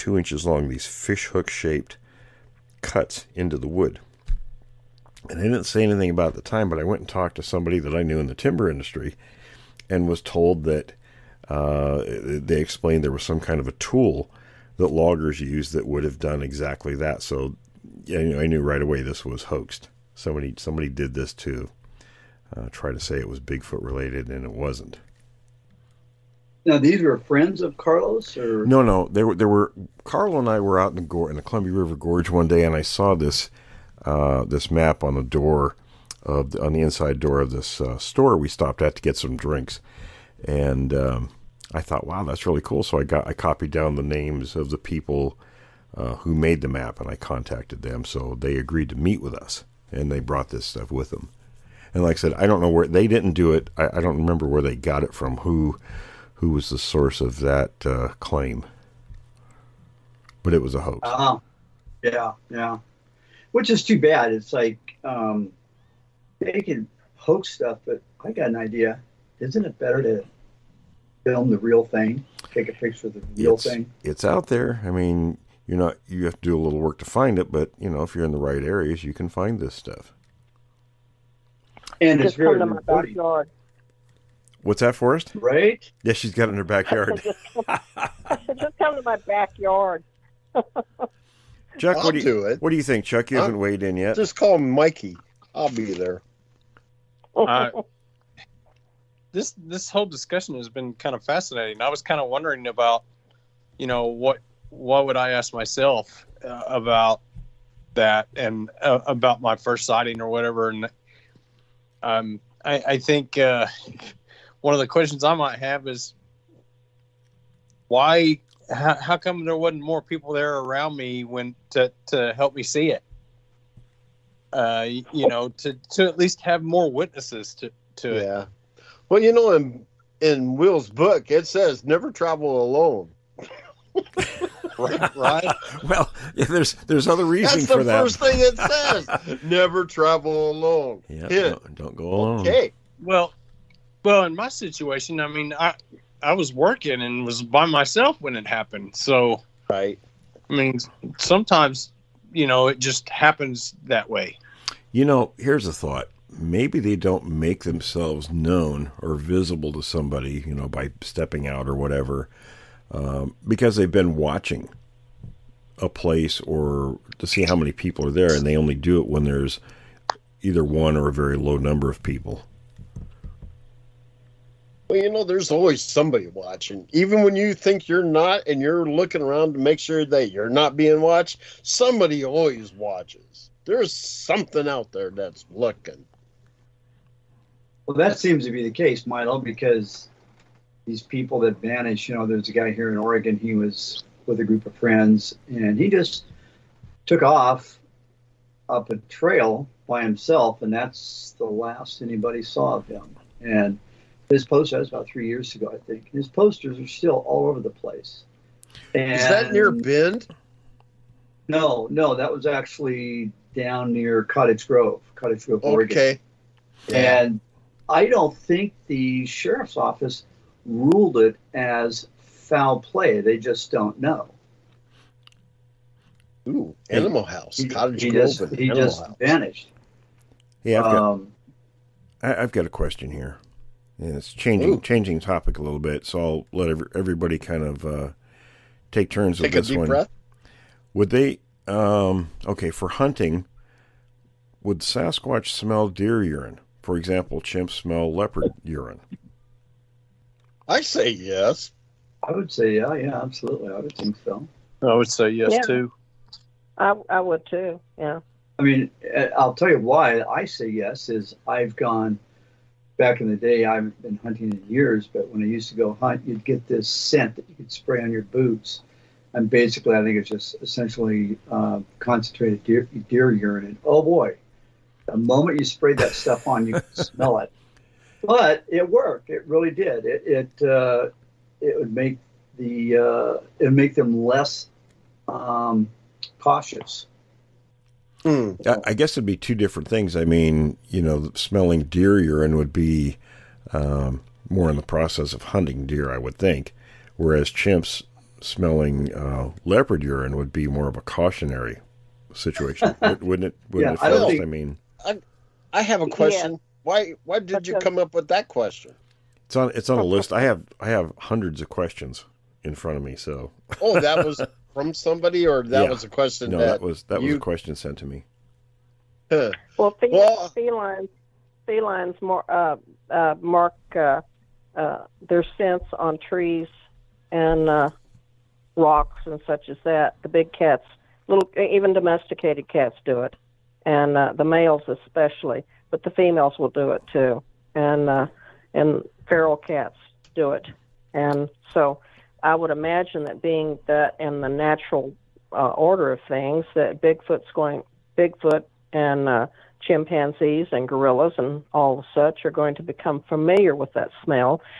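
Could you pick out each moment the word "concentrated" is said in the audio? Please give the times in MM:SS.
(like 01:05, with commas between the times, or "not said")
04:31.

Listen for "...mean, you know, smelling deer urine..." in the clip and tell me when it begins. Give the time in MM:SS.
04:50.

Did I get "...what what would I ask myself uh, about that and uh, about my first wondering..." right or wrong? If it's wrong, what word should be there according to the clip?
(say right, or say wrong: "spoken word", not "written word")
wrong: "sighting", not "wondering".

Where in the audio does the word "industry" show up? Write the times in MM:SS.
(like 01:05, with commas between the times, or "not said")
00:08.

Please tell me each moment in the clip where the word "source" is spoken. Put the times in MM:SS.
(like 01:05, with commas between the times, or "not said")
00:56.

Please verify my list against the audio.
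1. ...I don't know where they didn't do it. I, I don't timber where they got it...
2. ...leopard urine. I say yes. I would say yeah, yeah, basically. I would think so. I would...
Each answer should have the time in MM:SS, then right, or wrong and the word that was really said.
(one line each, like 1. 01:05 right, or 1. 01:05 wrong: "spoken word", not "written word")
1. 00:52 wrong: "remember", not "timber"
2. 04:08 wrong: "absolutely", not "basically".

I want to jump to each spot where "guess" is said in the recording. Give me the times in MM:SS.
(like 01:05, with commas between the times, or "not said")
04:48.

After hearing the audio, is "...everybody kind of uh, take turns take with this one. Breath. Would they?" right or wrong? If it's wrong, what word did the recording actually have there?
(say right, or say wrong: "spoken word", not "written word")
right.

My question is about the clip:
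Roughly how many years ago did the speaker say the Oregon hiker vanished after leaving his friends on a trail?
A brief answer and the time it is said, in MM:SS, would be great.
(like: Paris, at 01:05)
3, at 03:25.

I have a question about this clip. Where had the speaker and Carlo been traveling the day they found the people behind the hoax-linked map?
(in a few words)
Columbia River Gorge.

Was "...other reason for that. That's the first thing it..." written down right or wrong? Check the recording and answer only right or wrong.
right.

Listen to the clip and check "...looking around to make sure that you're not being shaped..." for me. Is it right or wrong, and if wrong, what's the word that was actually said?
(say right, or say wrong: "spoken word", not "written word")
wrong: "watched", not "shaped".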